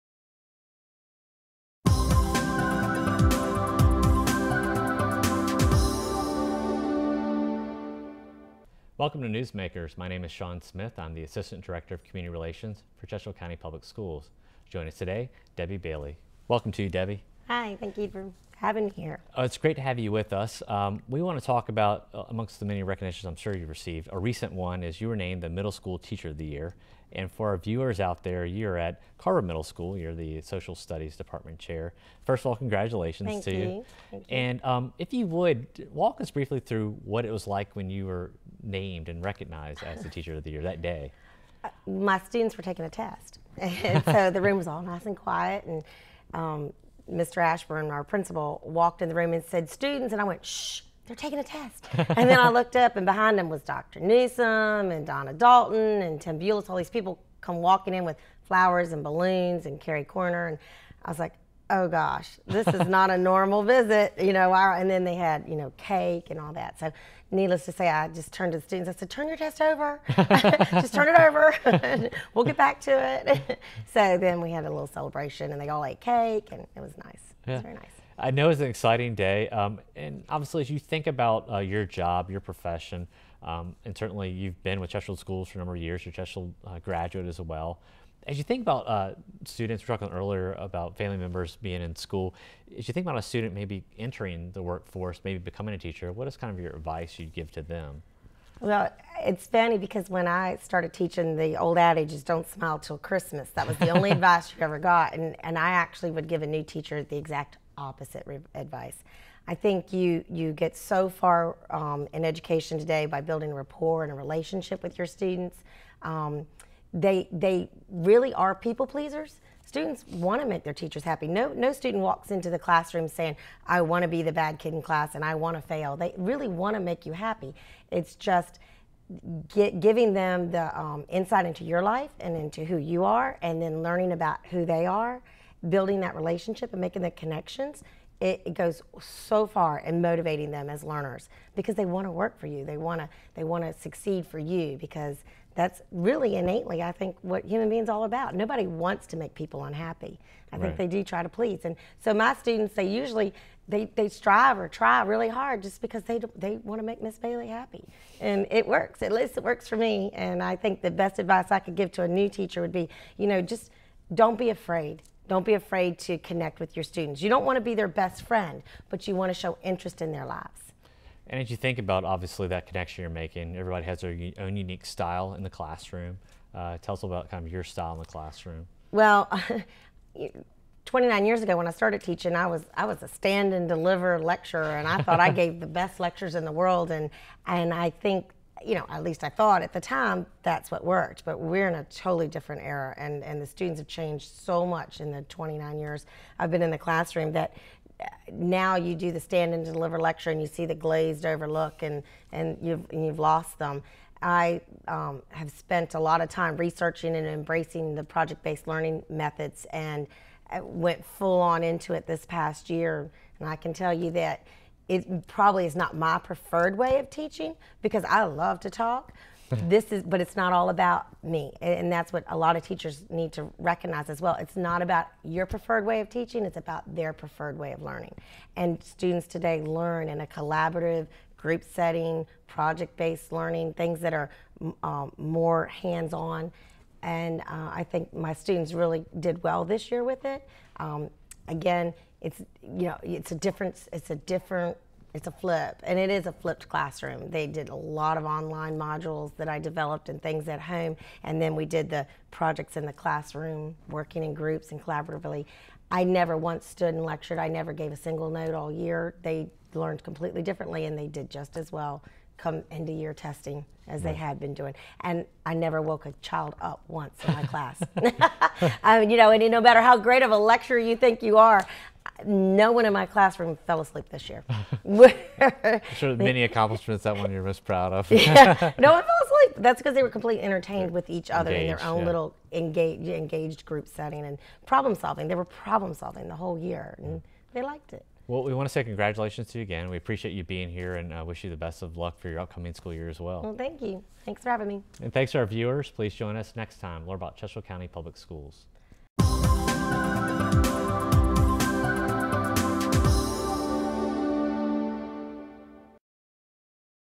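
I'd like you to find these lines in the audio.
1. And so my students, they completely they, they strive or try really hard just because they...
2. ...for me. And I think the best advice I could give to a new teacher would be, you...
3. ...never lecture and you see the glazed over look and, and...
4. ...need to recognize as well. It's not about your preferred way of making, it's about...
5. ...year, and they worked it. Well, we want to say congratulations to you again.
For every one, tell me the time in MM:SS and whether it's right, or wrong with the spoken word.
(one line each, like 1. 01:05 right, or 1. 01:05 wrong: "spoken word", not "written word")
1. 02:31 wrong: "usually", not "completely"
2. 02:39 right
3. 03:19 wrong: "deliver", not "never"
4. 03:43 wrong: "teaching", not "making"
5. 04:46 wrong: "liked", not "worked".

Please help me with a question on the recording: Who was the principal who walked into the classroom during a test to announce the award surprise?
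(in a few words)
Mr. Ashburn.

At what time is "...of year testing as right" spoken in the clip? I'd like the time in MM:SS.
04:22.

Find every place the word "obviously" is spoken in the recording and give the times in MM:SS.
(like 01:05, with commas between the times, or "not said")
01:20, 02:52.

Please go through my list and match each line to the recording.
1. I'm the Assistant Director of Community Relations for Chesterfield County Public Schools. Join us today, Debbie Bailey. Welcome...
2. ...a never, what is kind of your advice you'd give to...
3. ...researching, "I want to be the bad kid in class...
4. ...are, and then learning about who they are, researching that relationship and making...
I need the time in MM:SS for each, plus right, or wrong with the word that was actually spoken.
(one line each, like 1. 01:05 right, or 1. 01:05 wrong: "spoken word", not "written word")
1. 00:10 right
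2. 01:35 wrong: "teacher", not "never"
3. 02:03 wrong: "saying", not "researching"
4. 02:13 wrong: "building", not "researching".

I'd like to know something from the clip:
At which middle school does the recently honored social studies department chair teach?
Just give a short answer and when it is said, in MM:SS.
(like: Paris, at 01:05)
Carver Middle School, at 00:29.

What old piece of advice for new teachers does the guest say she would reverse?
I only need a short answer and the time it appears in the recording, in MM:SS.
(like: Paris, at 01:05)
Don't smile till Christmas, at 01:42.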